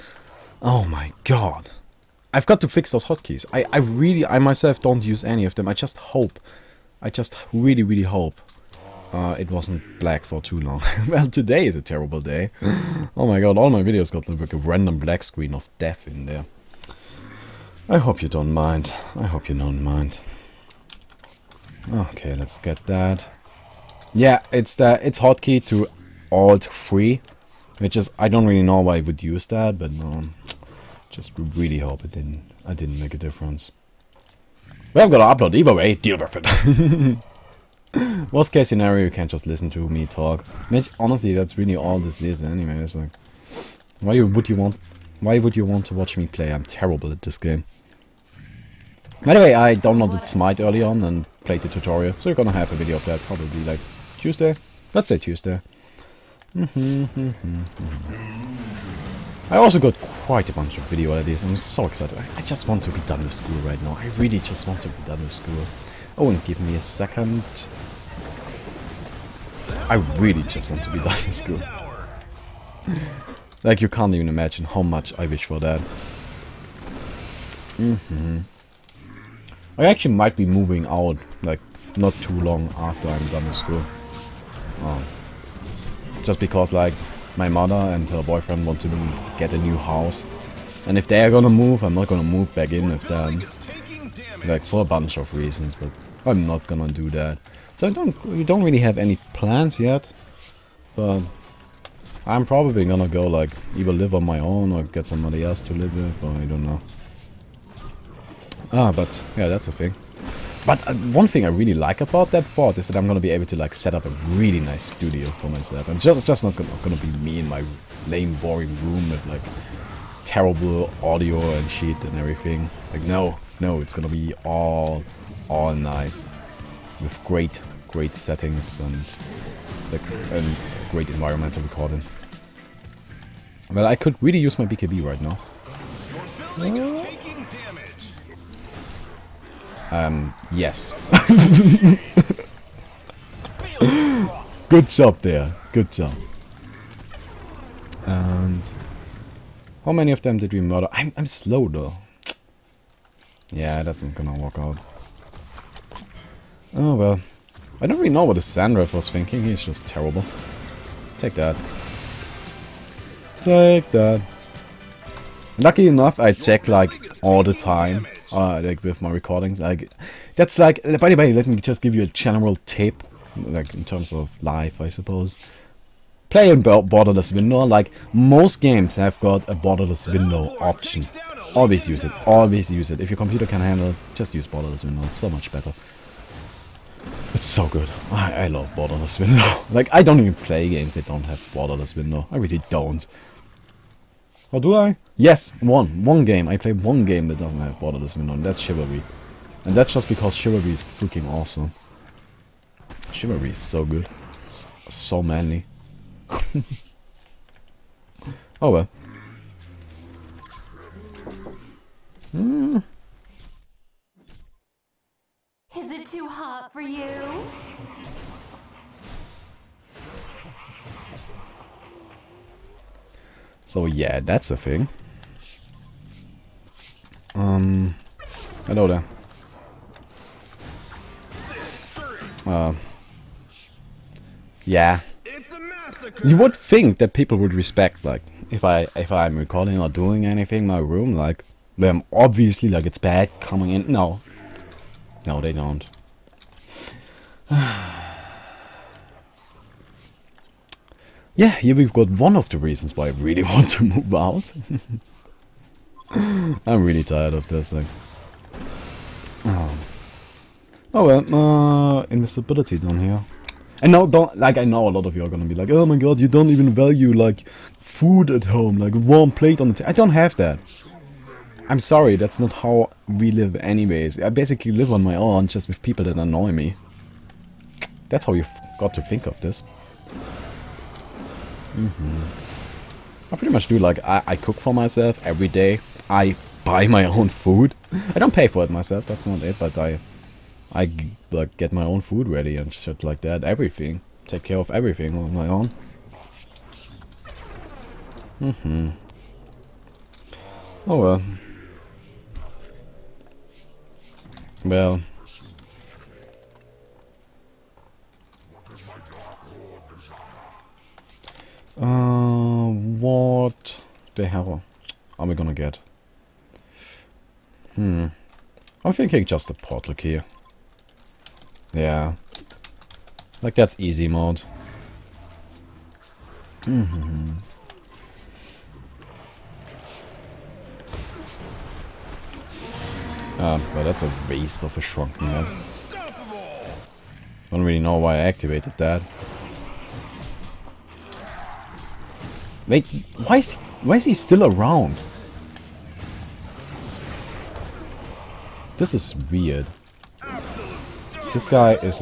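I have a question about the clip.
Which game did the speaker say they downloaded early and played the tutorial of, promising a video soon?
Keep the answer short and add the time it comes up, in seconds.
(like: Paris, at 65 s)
Smite, at 50 s.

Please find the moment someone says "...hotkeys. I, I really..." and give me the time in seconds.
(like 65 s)
3 s.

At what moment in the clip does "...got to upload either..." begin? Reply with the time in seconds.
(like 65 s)
35 s.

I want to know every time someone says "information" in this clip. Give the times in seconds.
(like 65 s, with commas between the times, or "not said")
not said.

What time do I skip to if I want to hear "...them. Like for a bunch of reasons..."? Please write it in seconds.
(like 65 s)
93 s.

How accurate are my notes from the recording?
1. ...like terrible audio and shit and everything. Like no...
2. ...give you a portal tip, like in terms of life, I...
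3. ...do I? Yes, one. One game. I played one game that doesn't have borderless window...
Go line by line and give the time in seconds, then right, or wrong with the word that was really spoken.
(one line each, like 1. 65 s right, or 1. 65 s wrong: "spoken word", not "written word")
1. 119 s right
2. 171 s wrong: "general", not "portal"
3. 194 s right.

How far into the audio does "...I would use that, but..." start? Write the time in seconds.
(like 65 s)
28 s.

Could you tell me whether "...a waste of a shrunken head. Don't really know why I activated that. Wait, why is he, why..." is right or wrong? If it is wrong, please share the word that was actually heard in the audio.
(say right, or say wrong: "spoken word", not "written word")
right.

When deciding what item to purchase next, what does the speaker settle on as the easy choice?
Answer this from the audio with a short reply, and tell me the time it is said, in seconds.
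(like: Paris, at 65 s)
portal key, at 319 s.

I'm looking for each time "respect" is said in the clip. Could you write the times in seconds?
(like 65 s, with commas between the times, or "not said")
237 s.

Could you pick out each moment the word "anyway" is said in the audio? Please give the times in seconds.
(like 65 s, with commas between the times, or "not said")
42 s, 273 s.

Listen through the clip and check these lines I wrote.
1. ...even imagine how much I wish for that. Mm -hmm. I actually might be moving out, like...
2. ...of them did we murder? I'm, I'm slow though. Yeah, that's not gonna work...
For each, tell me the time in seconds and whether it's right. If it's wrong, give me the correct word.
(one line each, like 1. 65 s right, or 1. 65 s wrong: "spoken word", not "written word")
1. 74 s right
2. 150 s right.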